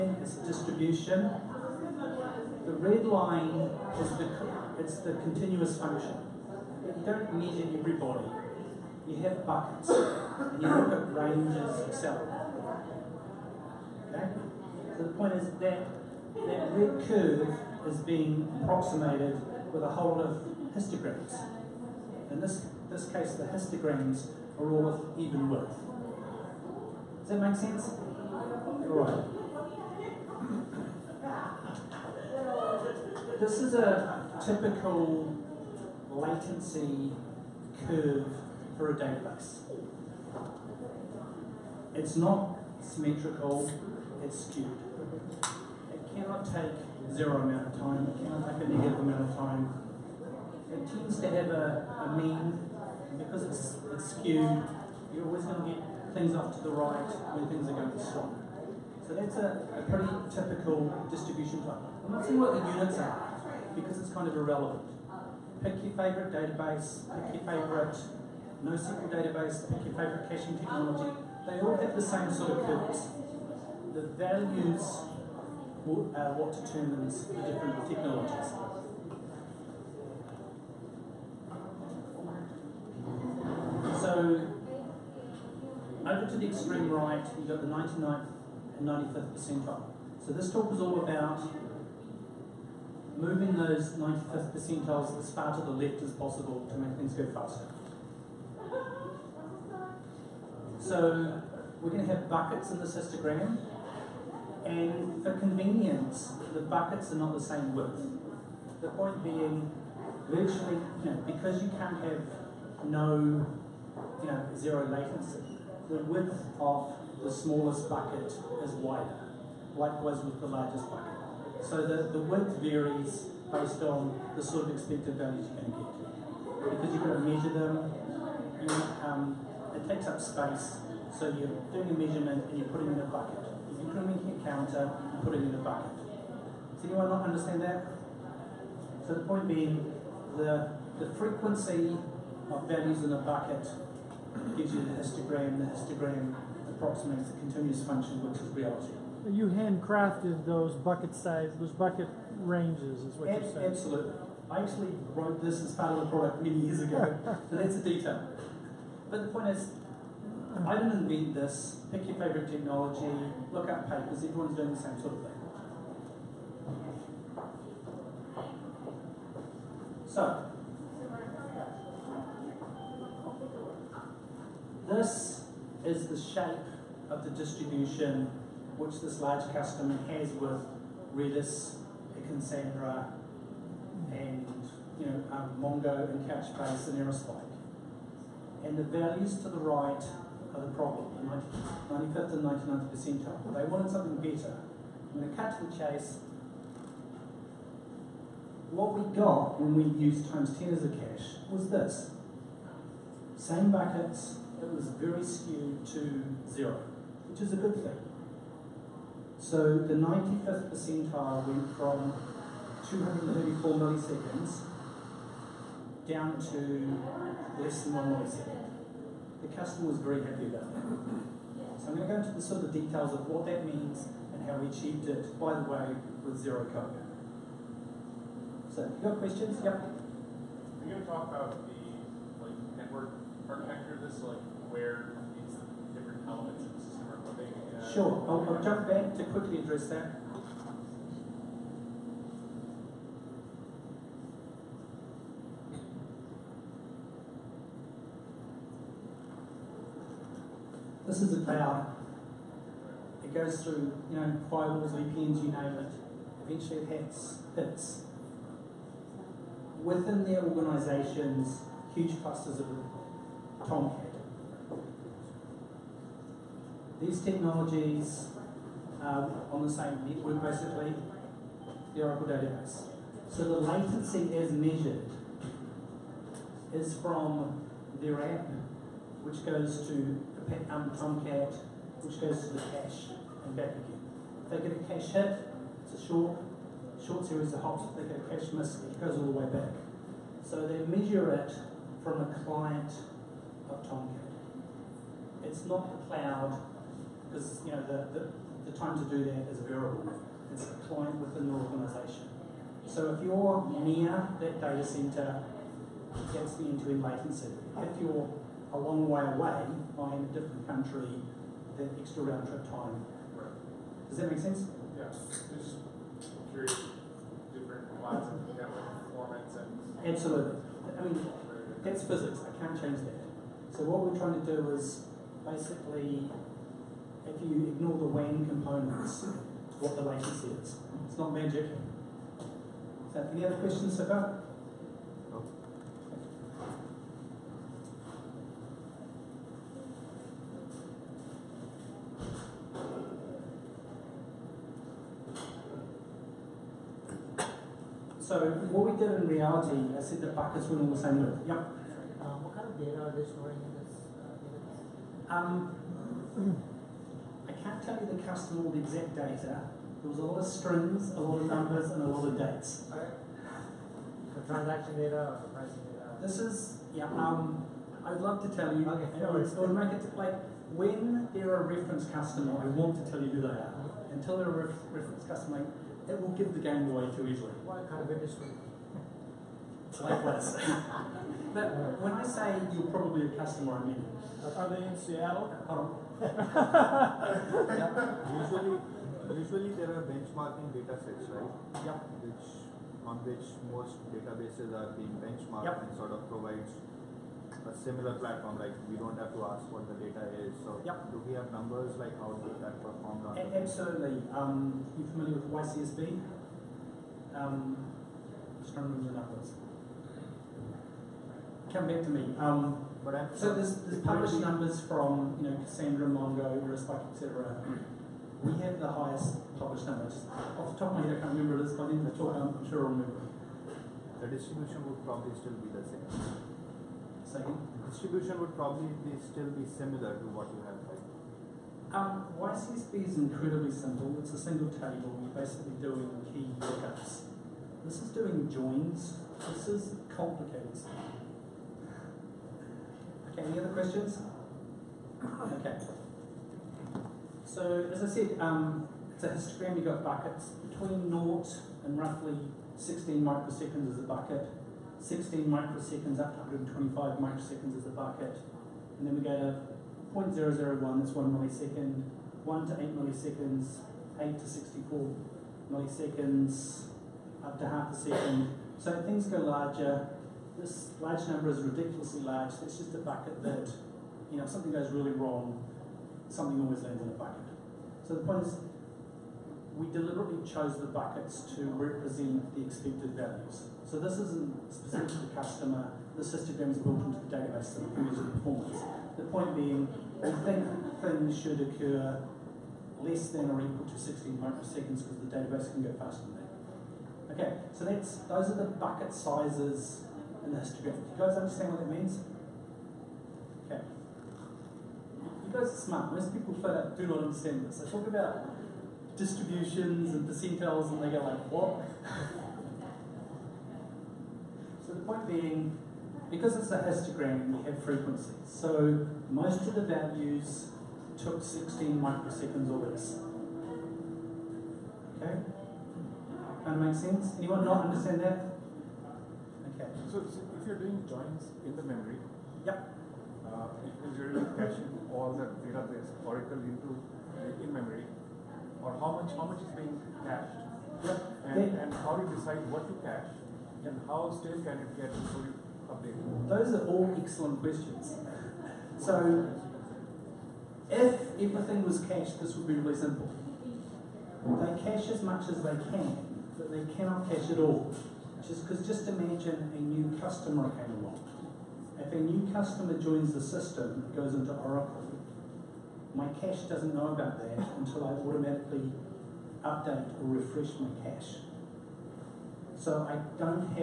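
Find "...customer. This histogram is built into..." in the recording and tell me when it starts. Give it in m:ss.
8:05.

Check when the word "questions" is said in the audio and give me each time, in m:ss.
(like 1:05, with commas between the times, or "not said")
3:49, 5:33, 7:23, 9:07.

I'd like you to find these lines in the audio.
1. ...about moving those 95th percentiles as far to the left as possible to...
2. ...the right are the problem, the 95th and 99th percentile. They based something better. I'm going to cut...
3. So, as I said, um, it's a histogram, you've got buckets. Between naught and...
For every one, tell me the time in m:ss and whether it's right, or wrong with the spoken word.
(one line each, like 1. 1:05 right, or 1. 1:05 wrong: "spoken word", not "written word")
1. 1:31 right
2. 3:09 wrong: "wanted", not "based"
3. 7:27 right.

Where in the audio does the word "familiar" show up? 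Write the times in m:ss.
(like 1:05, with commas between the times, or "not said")
6:45.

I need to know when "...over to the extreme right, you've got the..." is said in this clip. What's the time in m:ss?
1:26.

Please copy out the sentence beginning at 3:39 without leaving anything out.
The customer was very happy about that.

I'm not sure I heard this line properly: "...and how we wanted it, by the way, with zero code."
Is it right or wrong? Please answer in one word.
wrong.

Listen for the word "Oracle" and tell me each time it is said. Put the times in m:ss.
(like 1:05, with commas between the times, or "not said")
4:32, 8:56, 9:24.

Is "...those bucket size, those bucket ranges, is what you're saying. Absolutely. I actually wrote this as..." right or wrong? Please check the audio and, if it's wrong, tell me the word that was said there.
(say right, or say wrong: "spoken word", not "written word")
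right.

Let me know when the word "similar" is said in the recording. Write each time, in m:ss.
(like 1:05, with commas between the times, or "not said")
6:37, 7:09.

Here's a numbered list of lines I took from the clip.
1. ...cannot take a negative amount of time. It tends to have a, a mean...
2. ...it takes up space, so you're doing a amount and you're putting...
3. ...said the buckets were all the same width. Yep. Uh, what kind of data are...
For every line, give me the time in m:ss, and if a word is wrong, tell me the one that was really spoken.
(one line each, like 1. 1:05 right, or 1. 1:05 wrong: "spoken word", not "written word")
1. 0:48 right
2. 2:09 wrong: "measurement", not "amount"
3. 5:50 right.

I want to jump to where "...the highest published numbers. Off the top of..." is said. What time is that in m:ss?
6:58.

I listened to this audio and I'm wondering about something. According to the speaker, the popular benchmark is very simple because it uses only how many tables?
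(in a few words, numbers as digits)
1.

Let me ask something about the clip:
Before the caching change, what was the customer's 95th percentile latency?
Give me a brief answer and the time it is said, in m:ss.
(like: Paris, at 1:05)
234 milliseconds, at 3:32.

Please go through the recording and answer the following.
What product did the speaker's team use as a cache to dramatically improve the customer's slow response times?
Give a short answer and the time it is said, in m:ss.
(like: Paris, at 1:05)
TimesTen, at 3:20.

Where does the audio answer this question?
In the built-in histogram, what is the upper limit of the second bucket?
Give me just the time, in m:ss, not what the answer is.
7:36.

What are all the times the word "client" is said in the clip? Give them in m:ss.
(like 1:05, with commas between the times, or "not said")
4:52, 5:00.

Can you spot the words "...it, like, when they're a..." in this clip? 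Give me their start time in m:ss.
6:09.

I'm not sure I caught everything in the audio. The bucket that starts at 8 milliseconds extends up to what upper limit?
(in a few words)
64 milliseconds.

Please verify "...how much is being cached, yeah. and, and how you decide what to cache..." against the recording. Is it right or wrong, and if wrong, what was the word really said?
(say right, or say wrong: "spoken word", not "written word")
right.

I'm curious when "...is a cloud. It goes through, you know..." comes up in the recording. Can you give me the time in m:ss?
4:11.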